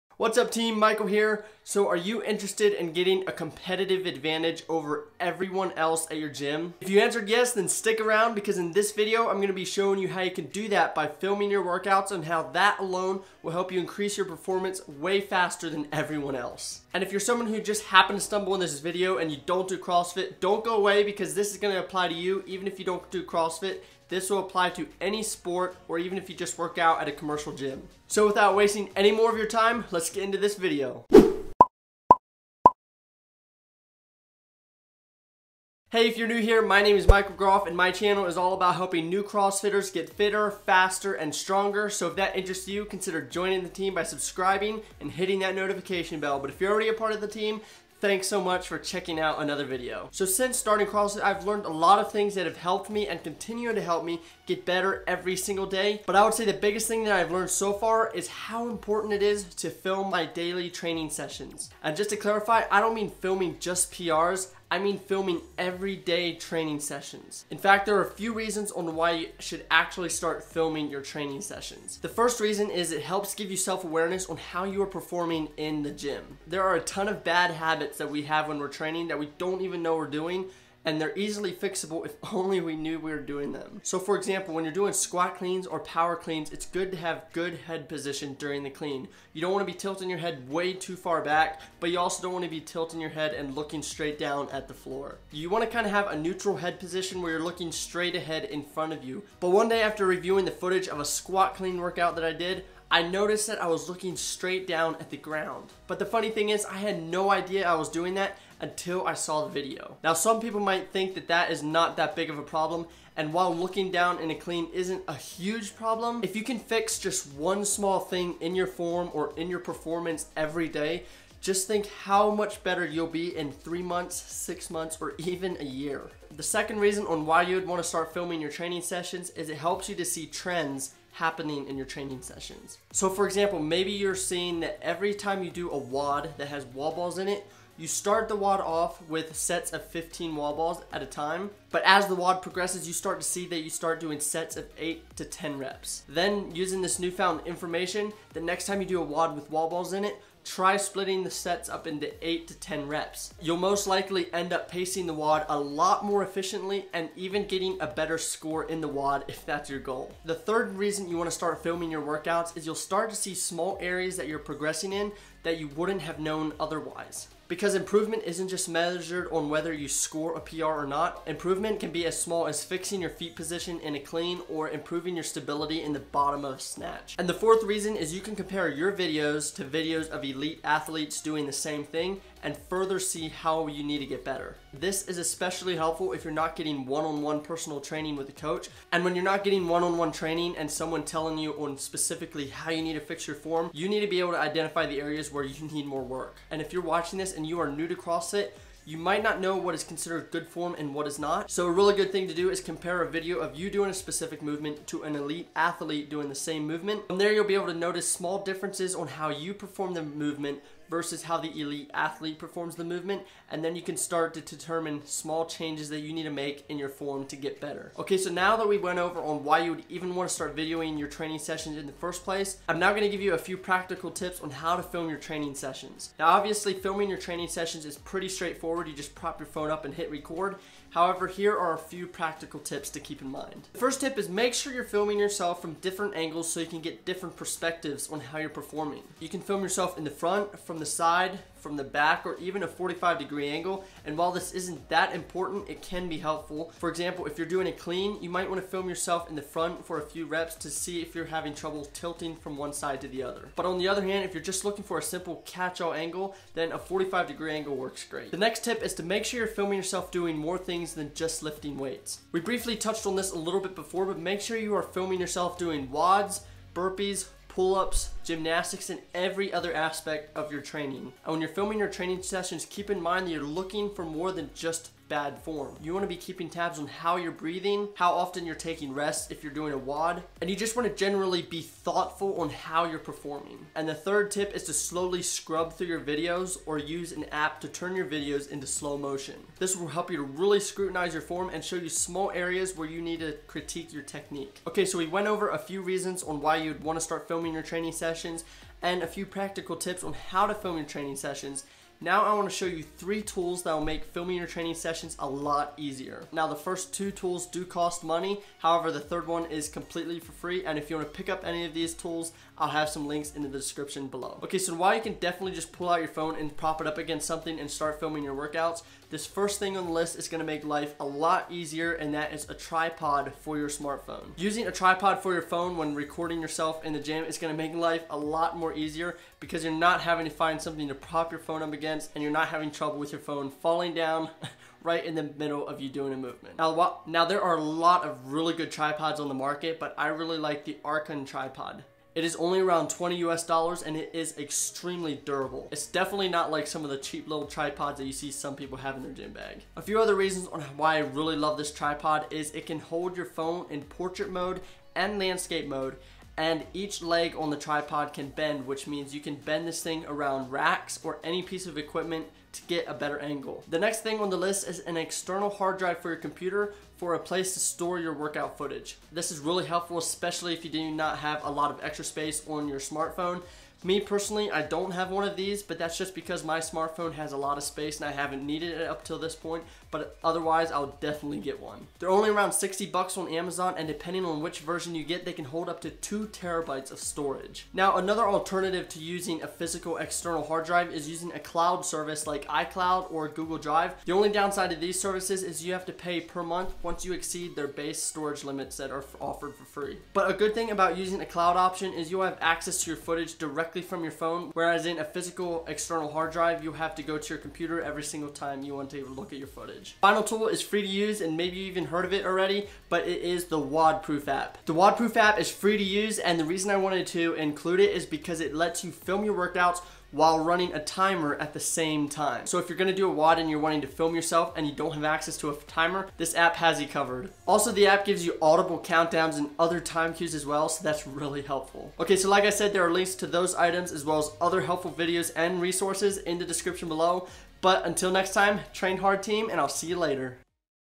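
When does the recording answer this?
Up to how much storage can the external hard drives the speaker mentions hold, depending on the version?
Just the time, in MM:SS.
06:25.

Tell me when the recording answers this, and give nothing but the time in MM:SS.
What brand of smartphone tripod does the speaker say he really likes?
05:40.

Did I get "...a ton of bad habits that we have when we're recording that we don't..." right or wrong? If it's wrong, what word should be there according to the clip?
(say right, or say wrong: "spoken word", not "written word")
wrong: "training", not "recording".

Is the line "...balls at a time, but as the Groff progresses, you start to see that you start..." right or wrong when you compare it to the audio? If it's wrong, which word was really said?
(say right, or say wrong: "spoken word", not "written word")
wrong: "WOD", not "Groff".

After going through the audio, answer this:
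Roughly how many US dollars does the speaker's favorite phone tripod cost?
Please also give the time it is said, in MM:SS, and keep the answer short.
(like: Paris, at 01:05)
20, at 05:42.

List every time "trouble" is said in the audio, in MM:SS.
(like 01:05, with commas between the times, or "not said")
04:11, 05:32.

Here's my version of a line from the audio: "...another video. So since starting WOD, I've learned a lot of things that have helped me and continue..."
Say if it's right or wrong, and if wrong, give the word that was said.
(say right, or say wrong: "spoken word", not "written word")
wrong: "CrossFit", not "WOD".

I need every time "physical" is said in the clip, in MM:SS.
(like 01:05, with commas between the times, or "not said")
06:29, 06:45.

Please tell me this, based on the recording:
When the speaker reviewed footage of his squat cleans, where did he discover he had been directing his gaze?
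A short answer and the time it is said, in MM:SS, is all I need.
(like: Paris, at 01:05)
straight down at the ground, at 01:44.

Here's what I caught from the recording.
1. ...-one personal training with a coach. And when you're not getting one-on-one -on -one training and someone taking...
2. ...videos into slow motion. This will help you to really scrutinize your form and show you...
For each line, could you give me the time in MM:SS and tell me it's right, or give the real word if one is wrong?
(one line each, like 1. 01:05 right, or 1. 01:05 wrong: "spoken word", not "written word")
1. 03:07 wrong: "telling", not "taking"
2. 04:48 right.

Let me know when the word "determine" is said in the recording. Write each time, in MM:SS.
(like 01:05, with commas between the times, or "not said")
03:34.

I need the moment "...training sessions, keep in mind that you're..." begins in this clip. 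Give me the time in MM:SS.
04:31.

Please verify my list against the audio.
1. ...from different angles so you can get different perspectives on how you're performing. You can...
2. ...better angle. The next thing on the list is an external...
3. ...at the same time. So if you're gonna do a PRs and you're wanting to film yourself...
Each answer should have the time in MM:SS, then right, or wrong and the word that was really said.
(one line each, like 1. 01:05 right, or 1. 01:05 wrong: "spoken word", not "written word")
1. 03:55 right
2. 06:02 right
3. 07:01 wrong: "WOD", not "PRs".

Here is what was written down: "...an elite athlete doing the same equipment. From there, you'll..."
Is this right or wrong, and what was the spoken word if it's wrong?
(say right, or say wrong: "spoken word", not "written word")
wrong: "movement", not "equipment".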